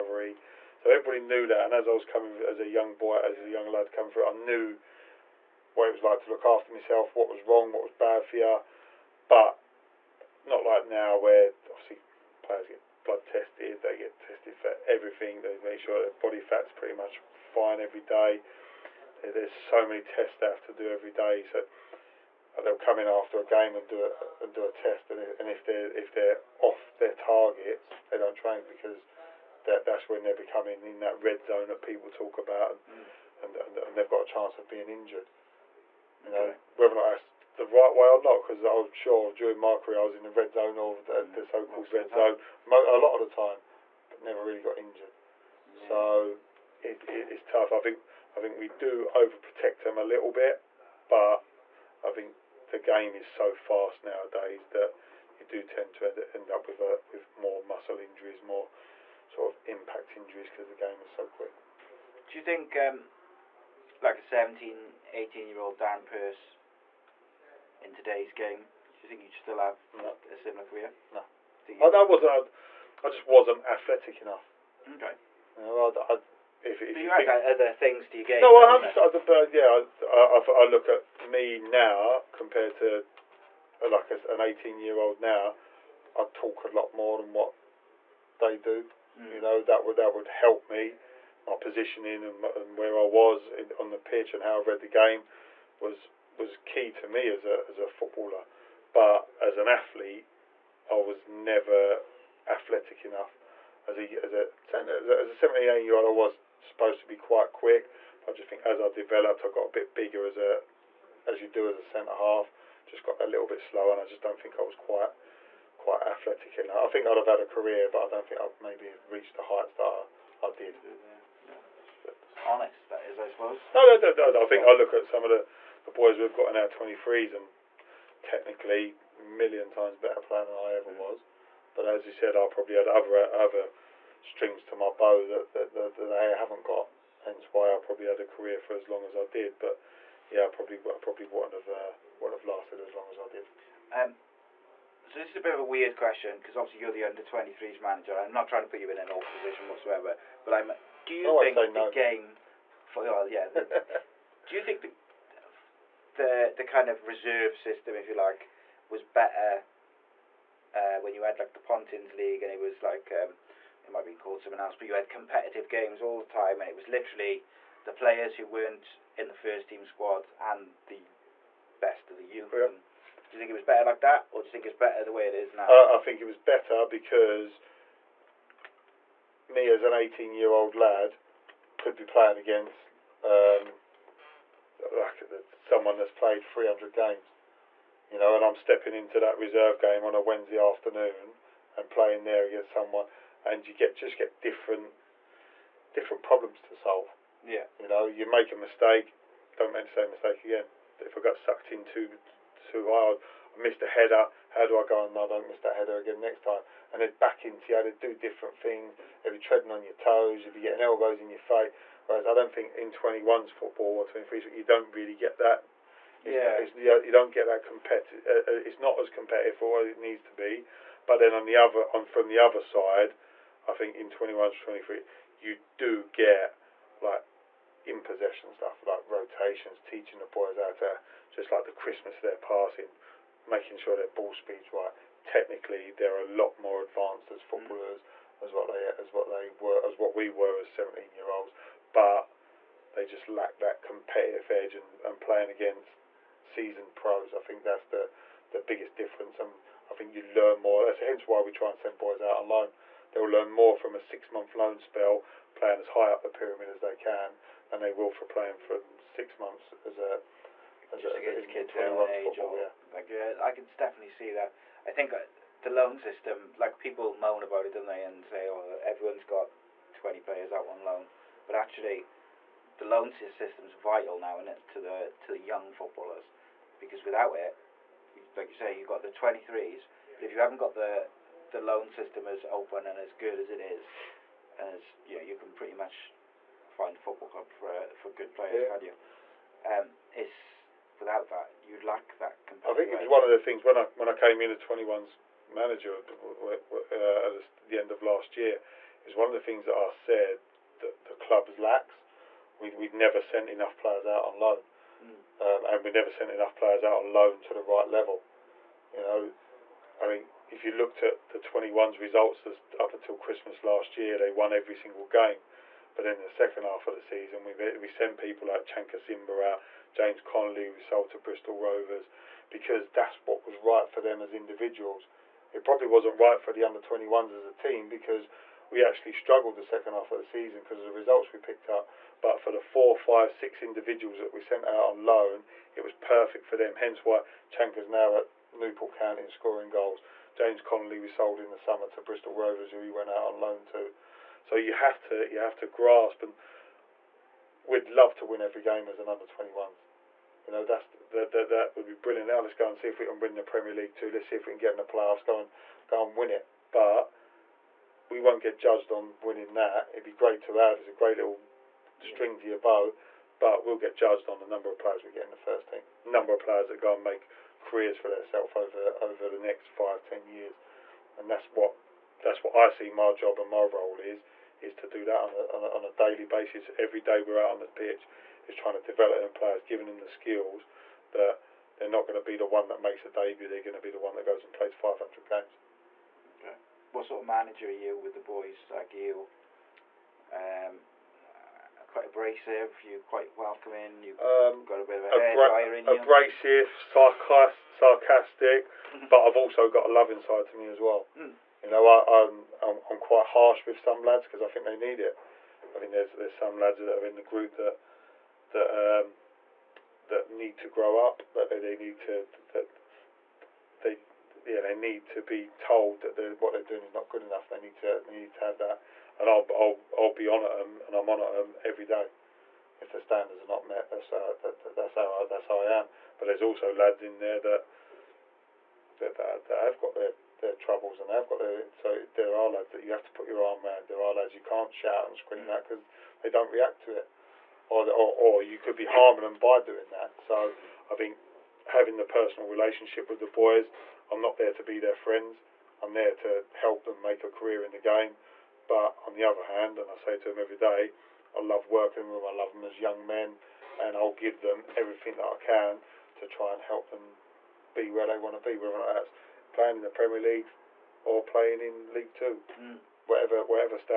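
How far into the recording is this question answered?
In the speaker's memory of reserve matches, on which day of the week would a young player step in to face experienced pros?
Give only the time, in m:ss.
3:10.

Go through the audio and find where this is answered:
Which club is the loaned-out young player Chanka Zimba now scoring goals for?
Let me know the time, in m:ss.
5:38.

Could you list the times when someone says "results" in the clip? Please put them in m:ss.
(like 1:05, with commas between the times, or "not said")
5:11, 5:30.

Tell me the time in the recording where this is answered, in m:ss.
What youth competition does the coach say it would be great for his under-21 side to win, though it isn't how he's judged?
5:53.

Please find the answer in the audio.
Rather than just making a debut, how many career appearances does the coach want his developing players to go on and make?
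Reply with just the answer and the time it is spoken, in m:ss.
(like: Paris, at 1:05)
500, at 6:24.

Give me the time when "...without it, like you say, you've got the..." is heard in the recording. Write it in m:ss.
4:37.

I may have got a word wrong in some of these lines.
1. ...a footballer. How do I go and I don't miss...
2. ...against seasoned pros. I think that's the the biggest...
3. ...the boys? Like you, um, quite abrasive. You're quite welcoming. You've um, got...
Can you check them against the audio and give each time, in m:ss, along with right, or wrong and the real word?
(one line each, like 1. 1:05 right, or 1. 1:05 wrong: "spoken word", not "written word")
1. 3:23 wrong: "header", not "footballer"
2. 4:05 right
3. 6:28 right.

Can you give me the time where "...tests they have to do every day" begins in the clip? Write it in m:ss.
0:20.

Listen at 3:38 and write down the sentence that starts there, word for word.
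Uh, uh, it's not as competitive for what it needs to be.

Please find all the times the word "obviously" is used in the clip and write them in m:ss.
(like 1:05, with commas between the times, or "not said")
0:11, 2:26.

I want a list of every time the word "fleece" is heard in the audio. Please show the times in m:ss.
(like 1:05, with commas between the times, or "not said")
not said.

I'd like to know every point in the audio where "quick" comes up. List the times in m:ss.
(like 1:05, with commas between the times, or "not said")
1:01, 1:47.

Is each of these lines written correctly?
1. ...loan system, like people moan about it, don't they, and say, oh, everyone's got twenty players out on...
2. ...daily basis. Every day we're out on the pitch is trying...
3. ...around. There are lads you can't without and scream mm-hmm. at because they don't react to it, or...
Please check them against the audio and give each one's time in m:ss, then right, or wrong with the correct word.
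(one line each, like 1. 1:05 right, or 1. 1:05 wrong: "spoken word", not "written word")
1. 4:25 right
2. 6:15 right
3. 7:13 wrong: "shout", not "without".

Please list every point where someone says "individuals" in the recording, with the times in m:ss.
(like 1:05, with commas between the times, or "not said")
5:24, 5:33.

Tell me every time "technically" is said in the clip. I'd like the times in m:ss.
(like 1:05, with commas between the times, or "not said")
2:08, 3:55.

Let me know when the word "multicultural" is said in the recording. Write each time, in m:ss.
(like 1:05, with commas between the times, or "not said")
not said.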